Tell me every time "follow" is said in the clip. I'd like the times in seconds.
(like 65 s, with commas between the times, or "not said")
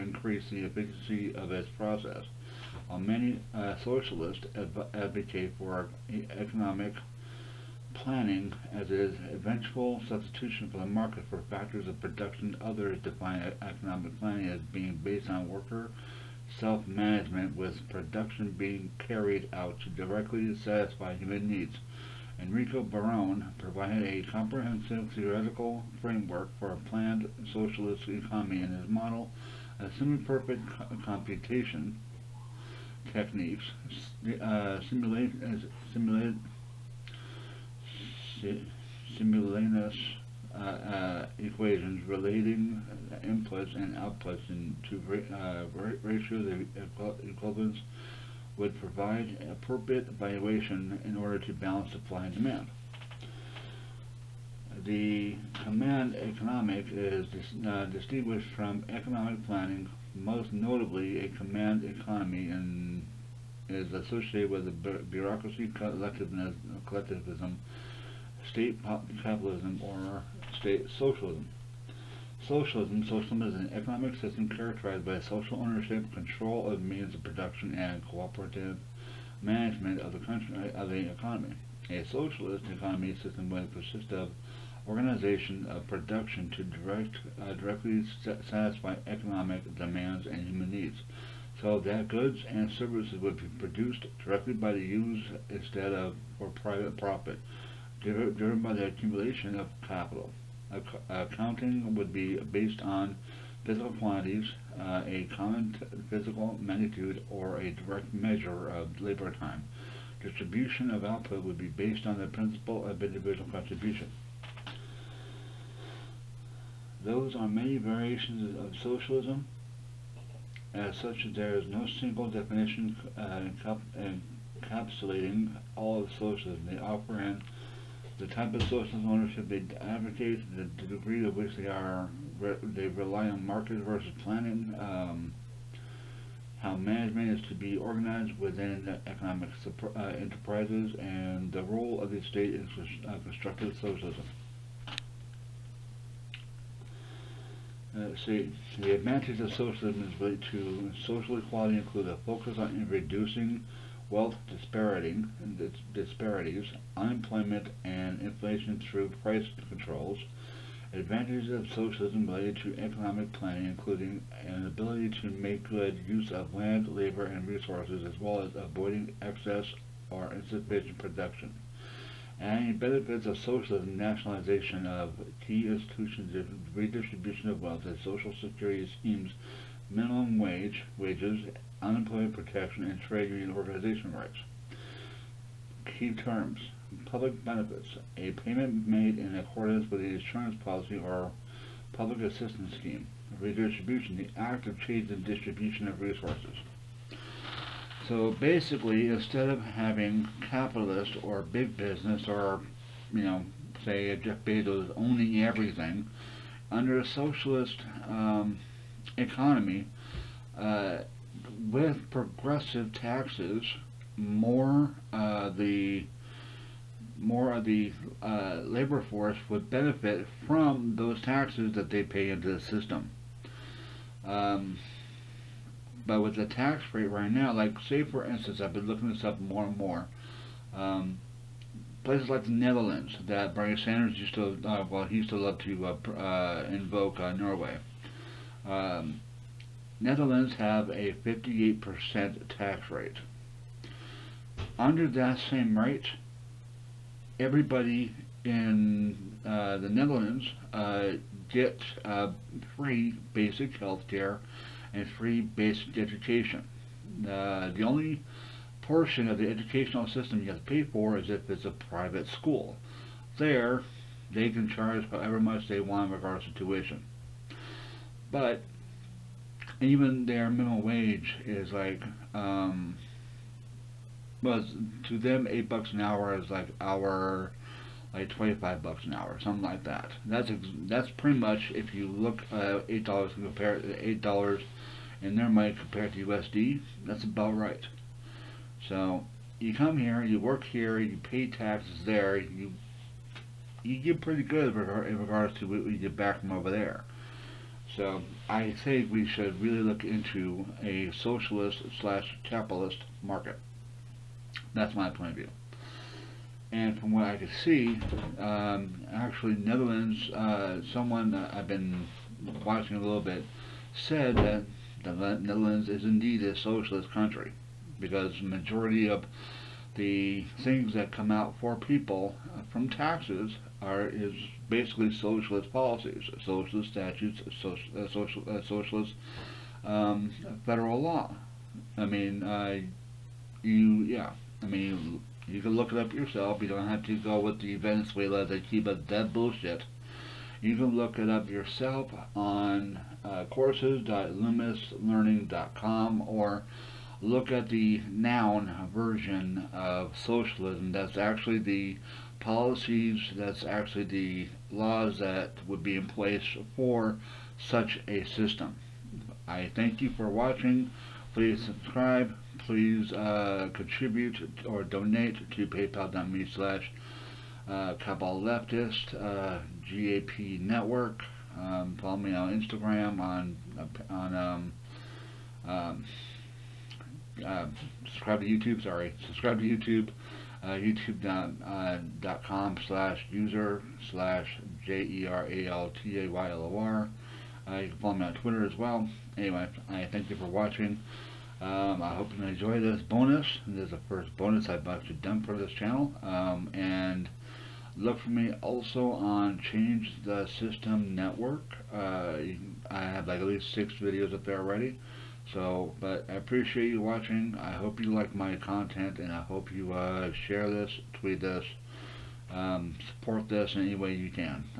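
372 s, 387 s.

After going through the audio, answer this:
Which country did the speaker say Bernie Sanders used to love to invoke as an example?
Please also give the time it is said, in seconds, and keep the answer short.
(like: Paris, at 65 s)
Norway, at 237 s.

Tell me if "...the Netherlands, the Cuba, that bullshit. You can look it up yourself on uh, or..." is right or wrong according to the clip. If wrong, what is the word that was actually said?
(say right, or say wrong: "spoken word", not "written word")
wrong: "Venezuela", not "Netherlands".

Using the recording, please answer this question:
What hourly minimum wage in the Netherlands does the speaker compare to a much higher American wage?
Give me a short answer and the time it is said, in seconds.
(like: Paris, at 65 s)
8 dollars, at 275 s.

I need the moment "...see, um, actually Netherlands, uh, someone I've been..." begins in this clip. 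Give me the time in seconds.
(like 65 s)
307 s.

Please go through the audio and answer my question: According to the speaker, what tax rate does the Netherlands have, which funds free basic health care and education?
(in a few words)
58%.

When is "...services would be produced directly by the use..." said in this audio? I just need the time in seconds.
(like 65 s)
92 s.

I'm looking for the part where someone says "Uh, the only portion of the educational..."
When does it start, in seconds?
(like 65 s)
257 s.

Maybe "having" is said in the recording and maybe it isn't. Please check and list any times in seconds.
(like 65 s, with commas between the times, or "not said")
199 s.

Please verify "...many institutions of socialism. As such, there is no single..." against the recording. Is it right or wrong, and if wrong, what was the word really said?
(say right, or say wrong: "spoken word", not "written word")
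wrong: "variations", not "institutions".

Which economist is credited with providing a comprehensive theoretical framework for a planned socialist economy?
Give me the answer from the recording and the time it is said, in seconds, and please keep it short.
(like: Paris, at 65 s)
Enrico Barone, at 22 s.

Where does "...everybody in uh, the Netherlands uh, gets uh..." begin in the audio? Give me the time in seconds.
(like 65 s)
247 s.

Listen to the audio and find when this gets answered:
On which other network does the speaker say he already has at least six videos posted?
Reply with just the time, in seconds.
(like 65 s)
399 s.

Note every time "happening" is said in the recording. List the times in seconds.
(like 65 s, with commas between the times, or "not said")
not said.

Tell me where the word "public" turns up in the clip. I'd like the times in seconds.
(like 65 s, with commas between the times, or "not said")
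187 s, 191 s.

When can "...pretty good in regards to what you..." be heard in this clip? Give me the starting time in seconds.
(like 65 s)
294 s.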